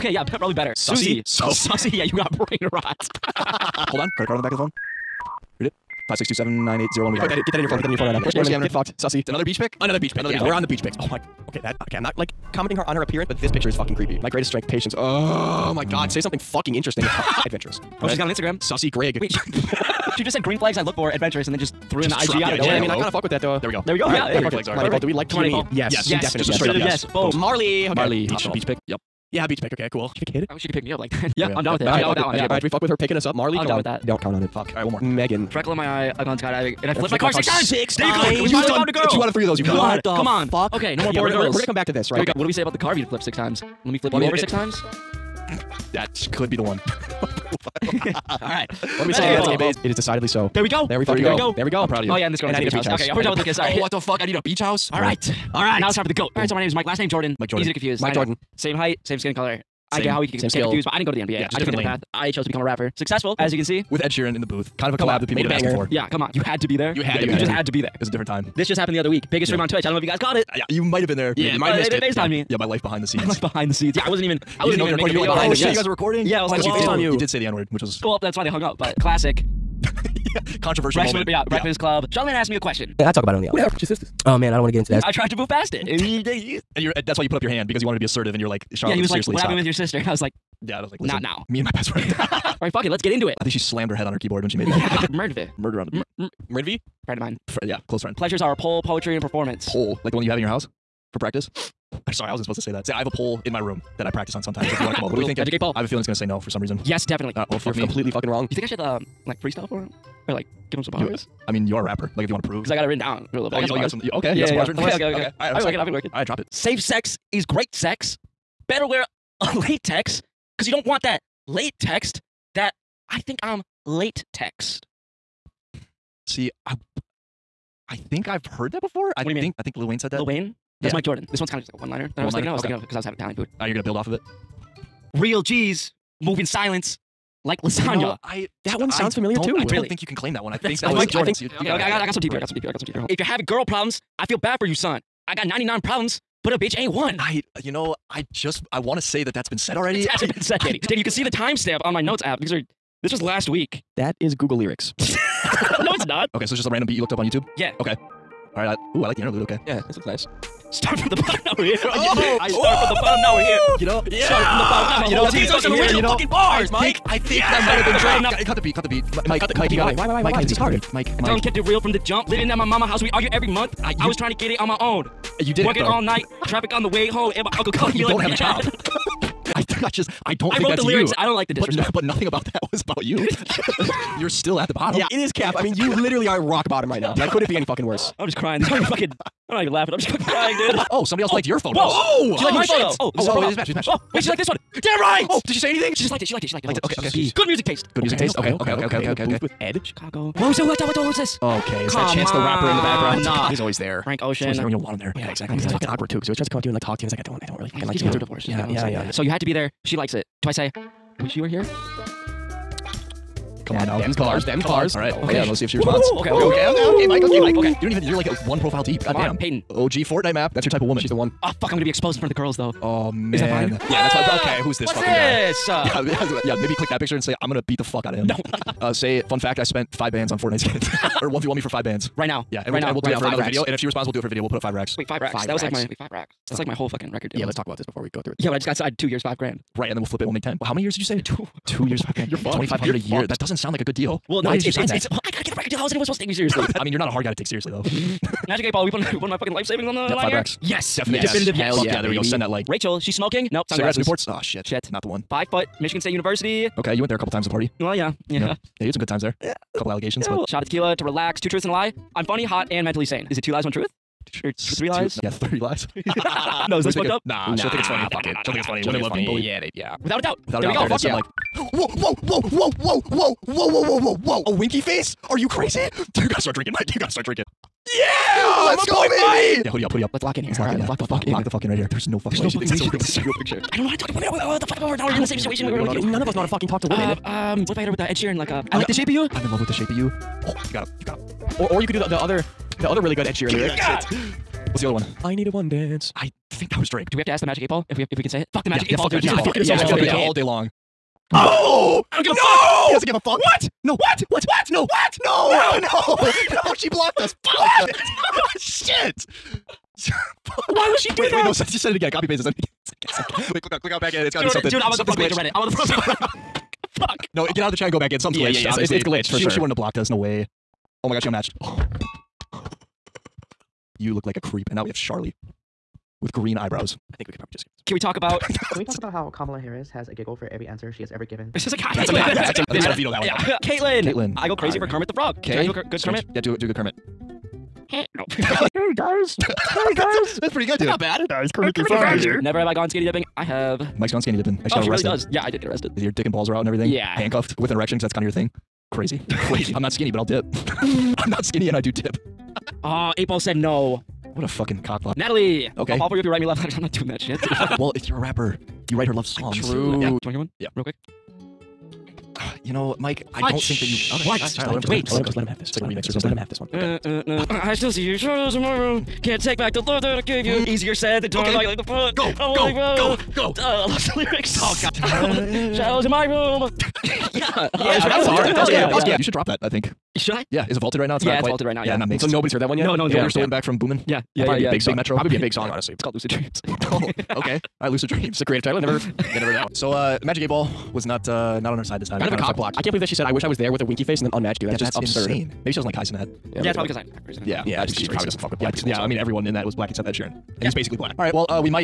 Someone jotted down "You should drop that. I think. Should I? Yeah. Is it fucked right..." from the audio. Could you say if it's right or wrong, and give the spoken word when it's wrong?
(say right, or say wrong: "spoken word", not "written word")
wrong: "vaulted", not "fucked".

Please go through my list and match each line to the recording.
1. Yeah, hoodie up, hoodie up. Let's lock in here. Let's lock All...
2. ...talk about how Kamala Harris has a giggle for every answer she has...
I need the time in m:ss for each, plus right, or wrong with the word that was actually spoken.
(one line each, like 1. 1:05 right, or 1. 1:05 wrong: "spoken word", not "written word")
1. 4:39 right
2. 5:28 right.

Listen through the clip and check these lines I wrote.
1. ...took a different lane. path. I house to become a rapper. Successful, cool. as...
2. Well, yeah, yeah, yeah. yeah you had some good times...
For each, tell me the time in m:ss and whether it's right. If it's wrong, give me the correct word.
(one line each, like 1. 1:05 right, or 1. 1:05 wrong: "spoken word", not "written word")
1. 1:01 wrong: "chose", not "house"
2. 4:17 right.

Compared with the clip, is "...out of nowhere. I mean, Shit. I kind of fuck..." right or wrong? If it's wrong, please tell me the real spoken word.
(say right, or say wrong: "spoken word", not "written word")
wrong: "Hello", not "Shit".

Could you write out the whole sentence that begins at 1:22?
Yeah, I talk about it on the album.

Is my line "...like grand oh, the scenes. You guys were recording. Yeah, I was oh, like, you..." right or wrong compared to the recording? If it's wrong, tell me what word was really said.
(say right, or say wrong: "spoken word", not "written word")
wrong: "behind", not "grand".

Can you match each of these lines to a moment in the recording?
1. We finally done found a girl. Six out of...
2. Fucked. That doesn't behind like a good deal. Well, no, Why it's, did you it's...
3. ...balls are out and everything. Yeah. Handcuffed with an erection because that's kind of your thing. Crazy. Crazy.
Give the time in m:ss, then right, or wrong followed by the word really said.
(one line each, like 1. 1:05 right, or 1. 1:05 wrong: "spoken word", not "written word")
1. 0:38 wrong: "Two", not "Six"
2. 4:03 wrong: "sound", not "behind"
3. 5:46 right.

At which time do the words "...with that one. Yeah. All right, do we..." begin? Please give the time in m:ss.
0:32.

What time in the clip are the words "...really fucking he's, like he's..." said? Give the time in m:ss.
3:27.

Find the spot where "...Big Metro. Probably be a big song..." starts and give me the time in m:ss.
6:24.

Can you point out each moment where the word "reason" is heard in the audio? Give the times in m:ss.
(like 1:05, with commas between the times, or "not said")
1:46.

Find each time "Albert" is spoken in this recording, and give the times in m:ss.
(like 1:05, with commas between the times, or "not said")
not said.